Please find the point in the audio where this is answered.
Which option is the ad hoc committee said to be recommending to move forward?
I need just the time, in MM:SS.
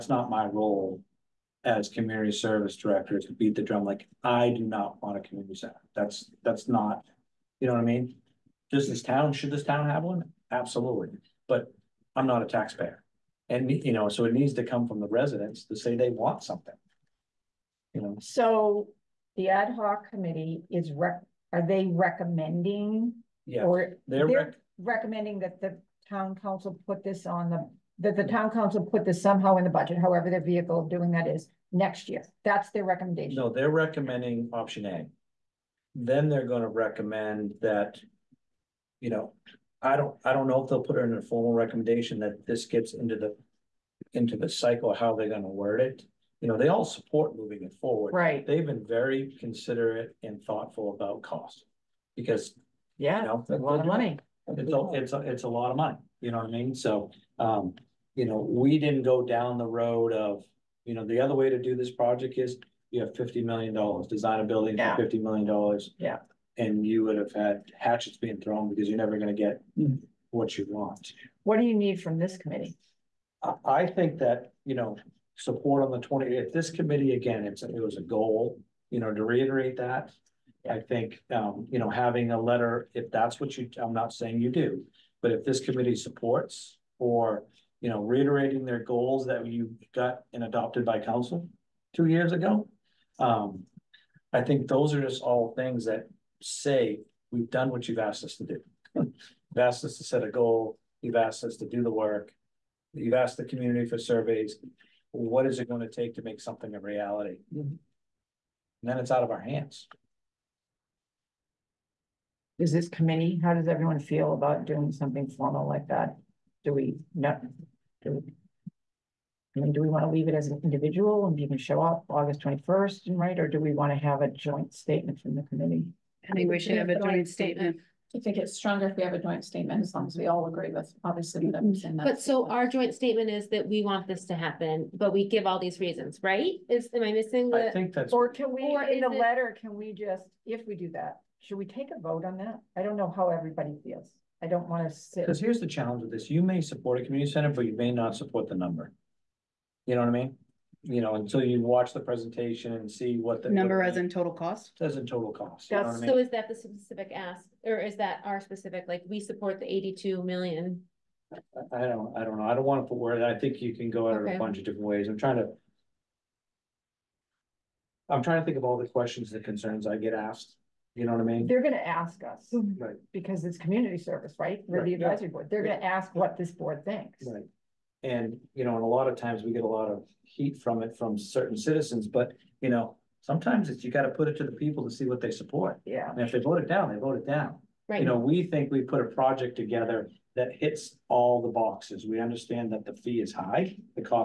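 00:34.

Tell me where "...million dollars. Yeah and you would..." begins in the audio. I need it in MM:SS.
01:05.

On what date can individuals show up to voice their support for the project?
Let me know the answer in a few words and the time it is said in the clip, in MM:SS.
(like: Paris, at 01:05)
August 21, at 02:02.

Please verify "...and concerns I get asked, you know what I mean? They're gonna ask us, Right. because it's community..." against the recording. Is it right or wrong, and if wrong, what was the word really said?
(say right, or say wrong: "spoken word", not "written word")
right.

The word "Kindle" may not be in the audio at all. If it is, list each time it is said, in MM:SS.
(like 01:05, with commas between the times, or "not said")
not said.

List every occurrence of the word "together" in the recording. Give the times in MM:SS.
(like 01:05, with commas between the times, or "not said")
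03:09.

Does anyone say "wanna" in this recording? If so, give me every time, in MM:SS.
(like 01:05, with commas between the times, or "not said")
02:24, 02:42.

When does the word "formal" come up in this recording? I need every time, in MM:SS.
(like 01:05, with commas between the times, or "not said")
00:41, 01:55.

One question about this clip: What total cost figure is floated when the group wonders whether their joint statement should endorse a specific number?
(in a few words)
$82 million.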